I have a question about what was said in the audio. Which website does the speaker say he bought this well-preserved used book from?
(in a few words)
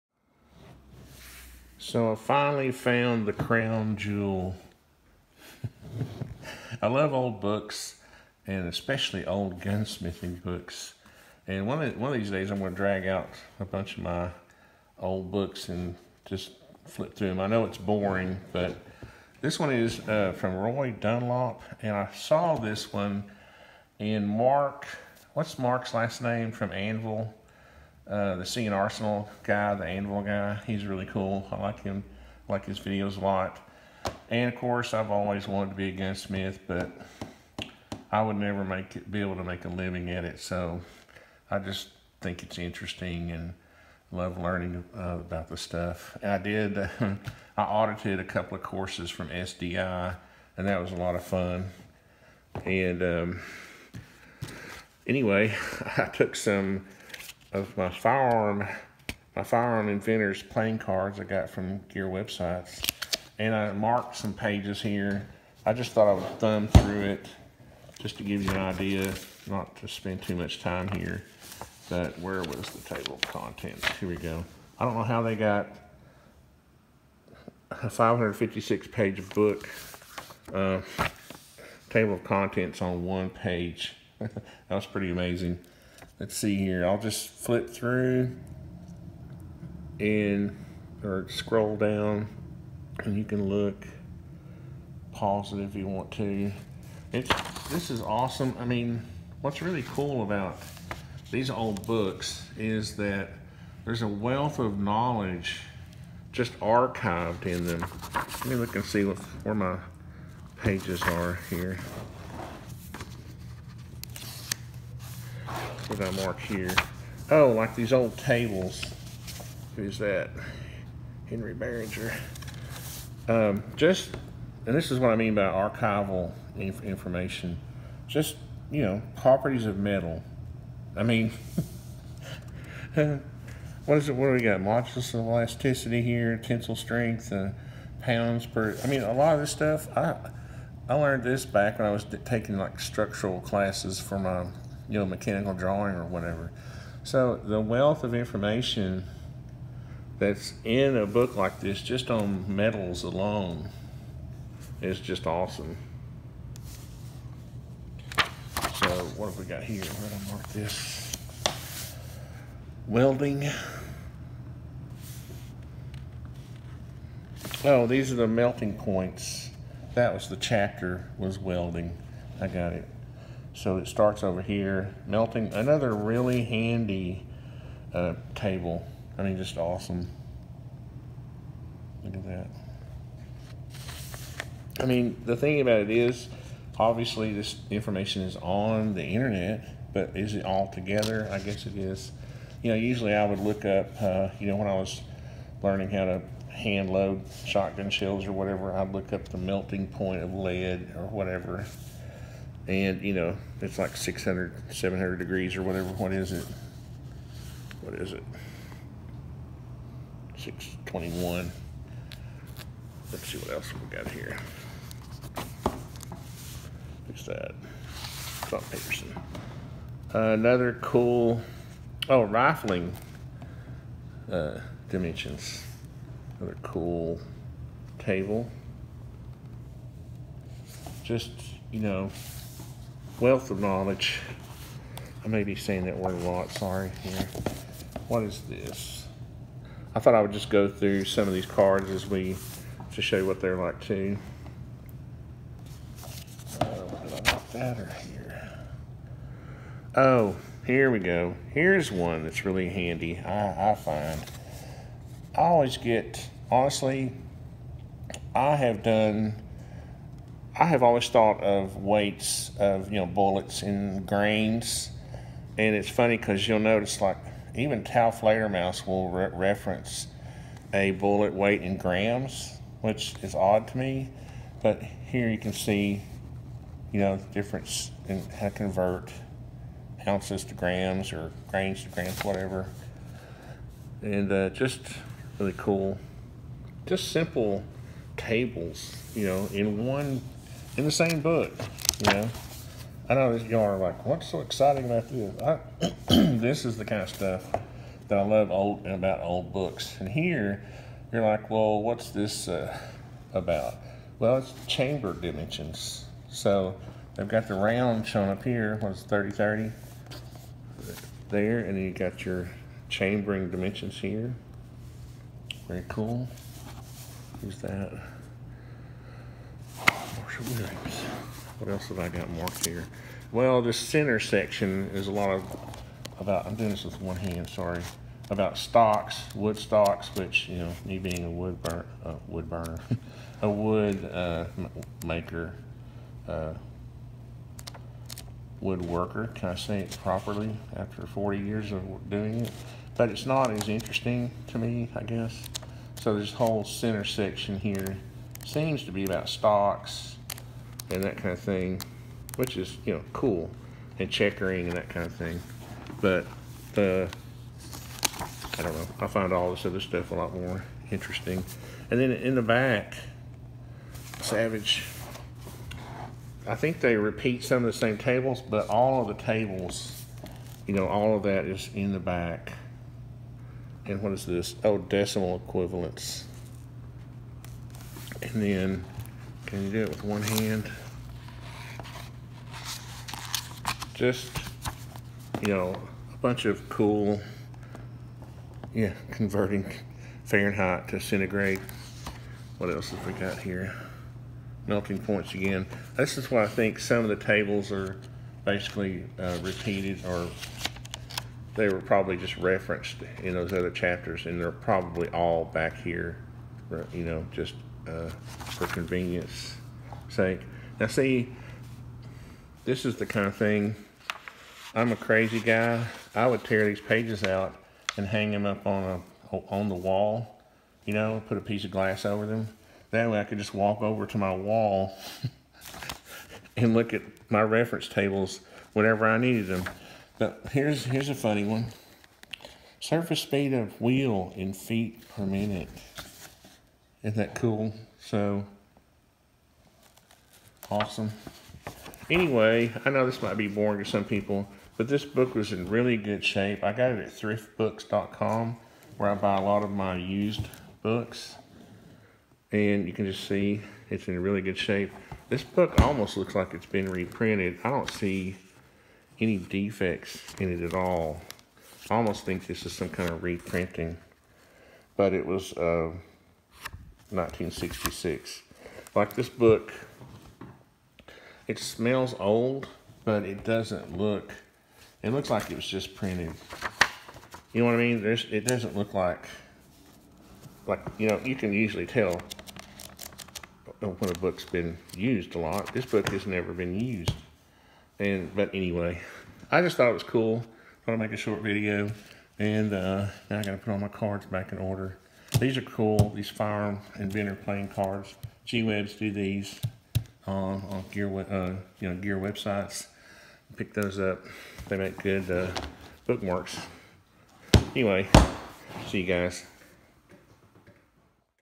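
thriftbooks.com.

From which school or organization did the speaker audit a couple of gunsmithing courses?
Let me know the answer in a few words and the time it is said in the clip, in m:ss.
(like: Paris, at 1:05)
SDI, at 0:49.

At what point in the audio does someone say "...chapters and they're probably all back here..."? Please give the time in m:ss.
6:43.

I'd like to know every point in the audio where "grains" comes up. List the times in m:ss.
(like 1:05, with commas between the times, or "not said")
4:24, 4:41.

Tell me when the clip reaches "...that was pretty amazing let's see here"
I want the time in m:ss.
1:24.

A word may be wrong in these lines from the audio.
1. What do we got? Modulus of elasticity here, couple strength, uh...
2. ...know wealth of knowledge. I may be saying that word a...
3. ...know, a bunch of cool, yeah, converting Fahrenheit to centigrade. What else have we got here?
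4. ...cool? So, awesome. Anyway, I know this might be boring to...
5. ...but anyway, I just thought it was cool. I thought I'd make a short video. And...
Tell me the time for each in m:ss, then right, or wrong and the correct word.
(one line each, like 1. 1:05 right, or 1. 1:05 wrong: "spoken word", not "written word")
1. 2:14 wrong: "tensile", not "couple"
2. 3:51 right
3. 6:25 right
4. 7:17 right
5. 8:08 right.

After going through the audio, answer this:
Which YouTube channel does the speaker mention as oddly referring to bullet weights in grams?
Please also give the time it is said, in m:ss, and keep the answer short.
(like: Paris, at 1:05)
Taofledermaus, at 4:27.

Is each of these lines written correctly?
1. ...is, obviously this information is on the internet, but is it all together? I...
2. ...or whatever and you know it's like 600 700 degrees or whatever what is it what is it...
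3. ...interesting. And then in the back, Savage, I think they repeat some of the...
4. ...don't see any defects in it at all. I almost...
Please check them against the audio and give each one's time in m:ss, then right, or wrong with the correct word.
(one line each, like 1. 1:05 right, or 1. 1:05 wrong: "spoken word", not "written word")
1. 3:05 right
2. 3:20 right
3. 6:00 right
4. 7:37 right.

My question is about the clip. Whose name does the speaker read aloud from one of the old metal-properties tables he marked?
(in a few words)
Henry Barringer.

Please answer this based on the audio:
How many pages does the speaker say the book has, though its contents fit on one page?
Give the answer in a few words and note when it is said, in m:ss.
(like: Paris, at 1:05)
556, at 1:17.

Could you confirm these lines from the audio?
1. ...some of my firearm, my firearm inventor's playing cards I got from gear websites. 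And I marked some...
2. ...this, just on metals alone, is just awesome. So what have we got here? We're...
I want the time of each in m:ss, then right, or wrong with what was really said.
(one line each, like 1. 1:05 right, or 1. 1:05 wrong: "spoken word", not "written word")
1. 0:56 right
2. 2:31 right.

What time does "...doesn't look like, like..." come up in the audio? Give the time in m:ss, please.
7:58.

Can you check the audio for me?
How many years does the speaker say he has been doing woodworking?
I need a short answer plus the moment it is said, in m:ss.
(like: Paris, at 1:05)
40, at 5:41.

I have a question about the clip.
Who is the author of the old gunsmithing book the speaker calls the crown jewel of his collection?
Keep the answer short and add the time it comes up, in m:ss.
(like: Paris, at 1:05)
Roy Dunlap, at 0:20.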